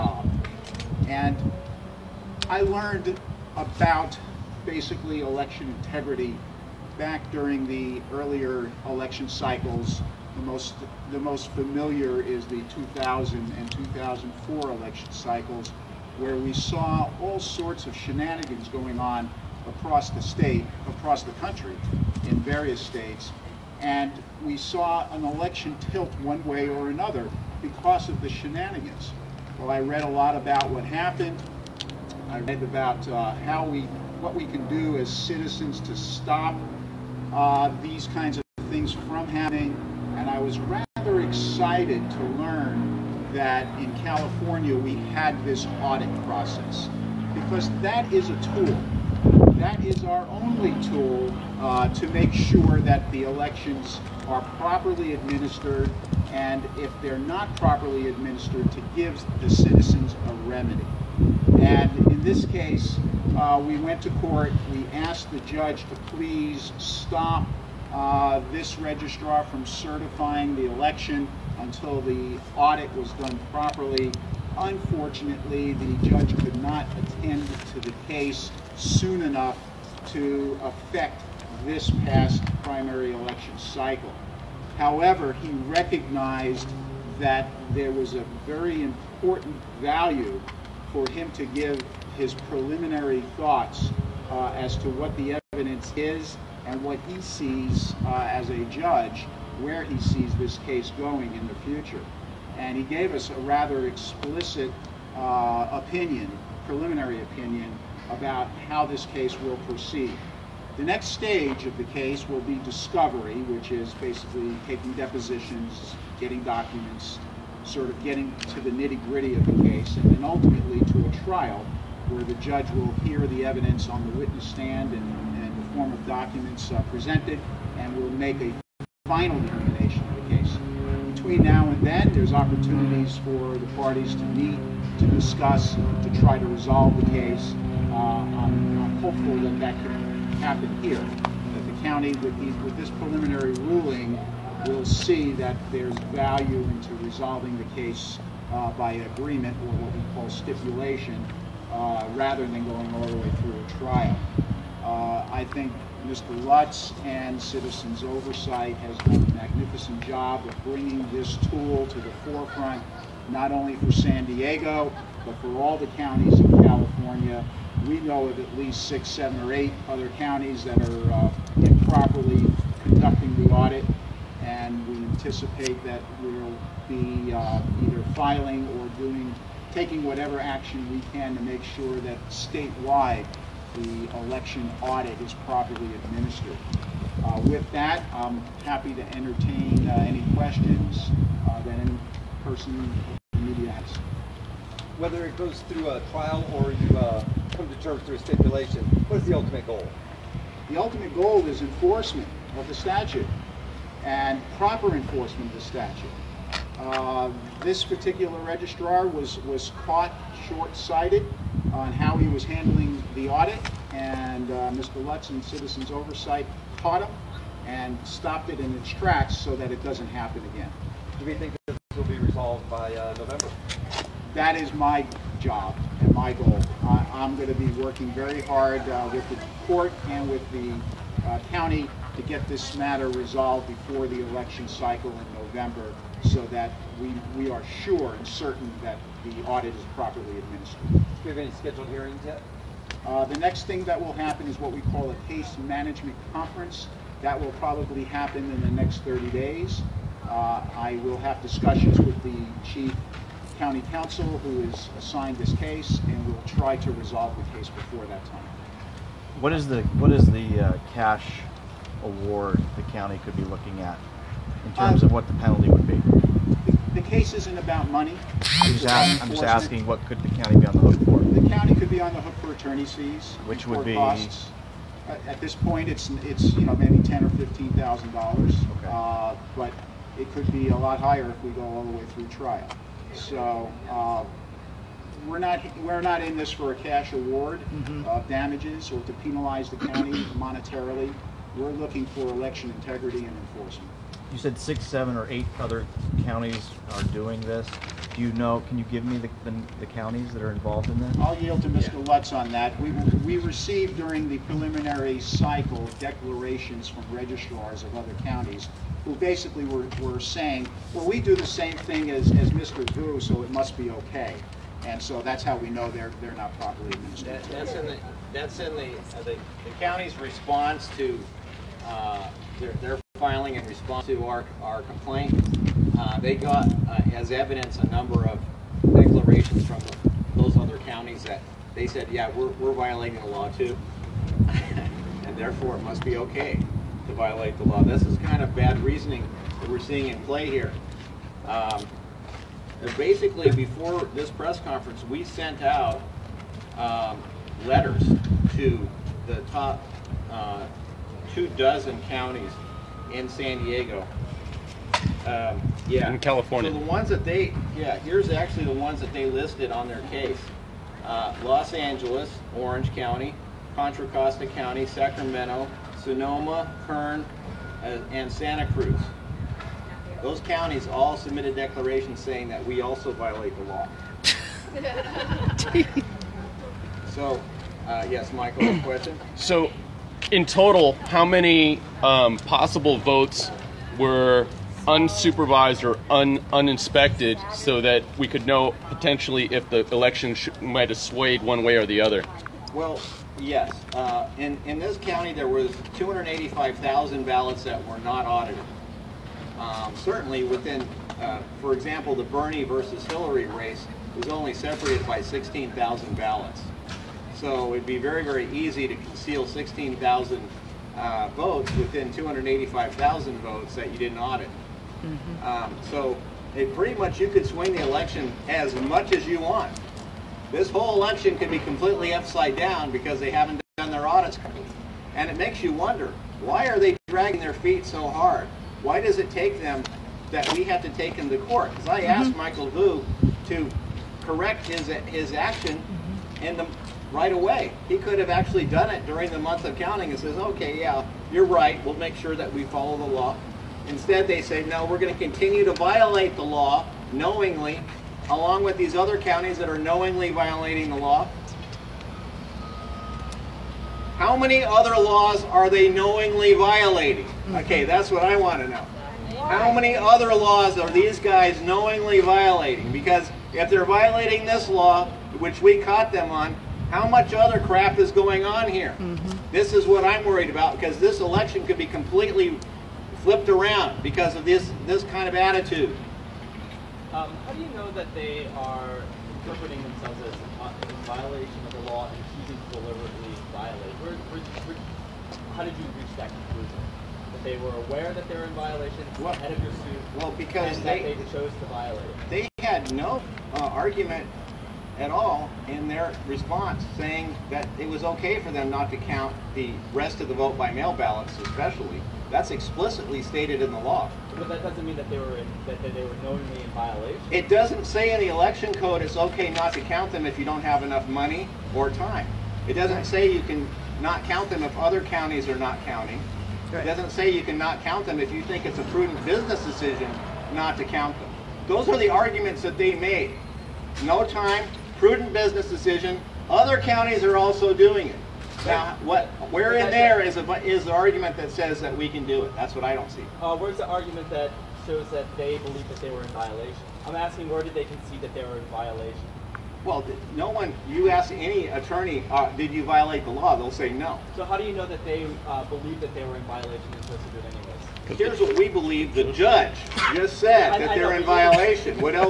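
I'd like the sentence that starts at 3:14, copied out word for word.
Whether it goes through a trial or you uh, come to terms through a stipulation, what is the ultimate goal?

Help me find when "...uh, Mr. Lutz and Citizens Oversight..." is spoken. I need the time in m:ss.
3:34.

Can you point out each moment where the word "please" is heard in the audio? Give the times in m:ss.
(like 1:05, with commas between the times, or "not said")
1:06.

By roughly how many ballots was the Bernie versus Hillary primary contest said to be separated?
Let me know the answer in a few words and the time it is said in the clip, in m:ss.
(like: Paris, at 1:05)
16,000, at 6:45.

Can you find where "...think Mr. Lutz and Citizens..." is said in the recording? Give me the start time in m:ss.
2:35.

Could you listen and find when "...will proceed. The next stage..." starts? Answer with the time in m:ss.
1:49.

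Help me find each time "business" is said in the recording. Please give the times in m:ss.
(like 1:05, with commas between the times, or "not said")
8:39, 8:45.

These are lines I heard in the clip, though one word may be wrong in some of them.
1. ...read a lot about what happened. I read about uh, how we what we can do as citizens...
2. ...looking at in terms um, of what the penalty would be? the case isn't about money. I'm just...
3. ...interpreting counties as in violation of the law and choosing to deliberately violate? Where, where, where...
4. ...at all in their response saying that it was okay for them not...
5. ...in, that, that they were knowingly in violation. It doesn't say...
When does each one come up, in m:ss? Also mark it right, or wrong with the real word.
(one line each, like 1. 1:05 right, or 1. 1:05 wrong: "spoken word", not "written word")
1. 0:29 right
2. 4:23 right
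3. 7:59 wrong: "themselves", not "counties"
4. 8:14 right
5. 8:25 right.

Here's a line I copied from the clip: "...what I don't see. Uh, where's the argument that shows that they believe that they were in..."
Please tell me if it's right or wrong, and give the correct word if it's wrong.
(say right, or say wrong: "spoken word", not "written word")
right.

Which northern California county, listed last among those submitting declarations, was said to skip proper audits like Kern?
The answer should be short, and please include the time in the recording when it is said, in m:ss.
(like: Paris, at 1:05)
Santa Cruz, at 6:08.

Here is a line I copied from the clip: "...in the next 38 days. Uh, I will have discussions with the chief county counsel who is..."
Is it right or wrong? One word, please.
wrong.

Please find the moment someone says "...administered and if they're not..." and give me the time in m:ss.
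0:55.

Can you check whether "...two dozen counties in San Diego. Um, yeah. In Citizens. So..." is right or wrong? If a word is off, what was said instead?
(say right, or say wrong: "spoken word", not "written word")
wrong: "California", not "Citizens".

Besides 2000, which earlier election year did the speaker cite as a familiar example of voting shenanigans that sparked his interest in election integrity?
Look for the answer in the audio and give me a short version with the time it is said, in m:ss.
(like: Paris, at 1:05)
2004, at 0:13.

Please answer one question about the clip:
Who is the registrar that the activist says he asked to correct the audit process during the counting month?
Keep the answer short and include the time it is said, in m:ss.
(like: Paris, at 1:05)
Michael Vu, at 7:12.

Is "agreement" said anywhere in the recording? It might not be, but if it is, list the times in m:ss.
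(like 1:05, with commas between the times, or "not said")
2:28.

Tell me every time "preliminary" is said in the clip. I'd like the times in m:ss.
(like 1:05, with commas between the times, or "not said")
1:32, 1:46, 2:22, 5:04.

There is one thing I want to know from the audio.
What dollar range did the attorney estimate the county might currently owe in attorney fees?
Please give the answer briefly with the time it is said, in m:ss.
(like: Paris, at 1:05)
$10,000 to $15,000, at 4:37.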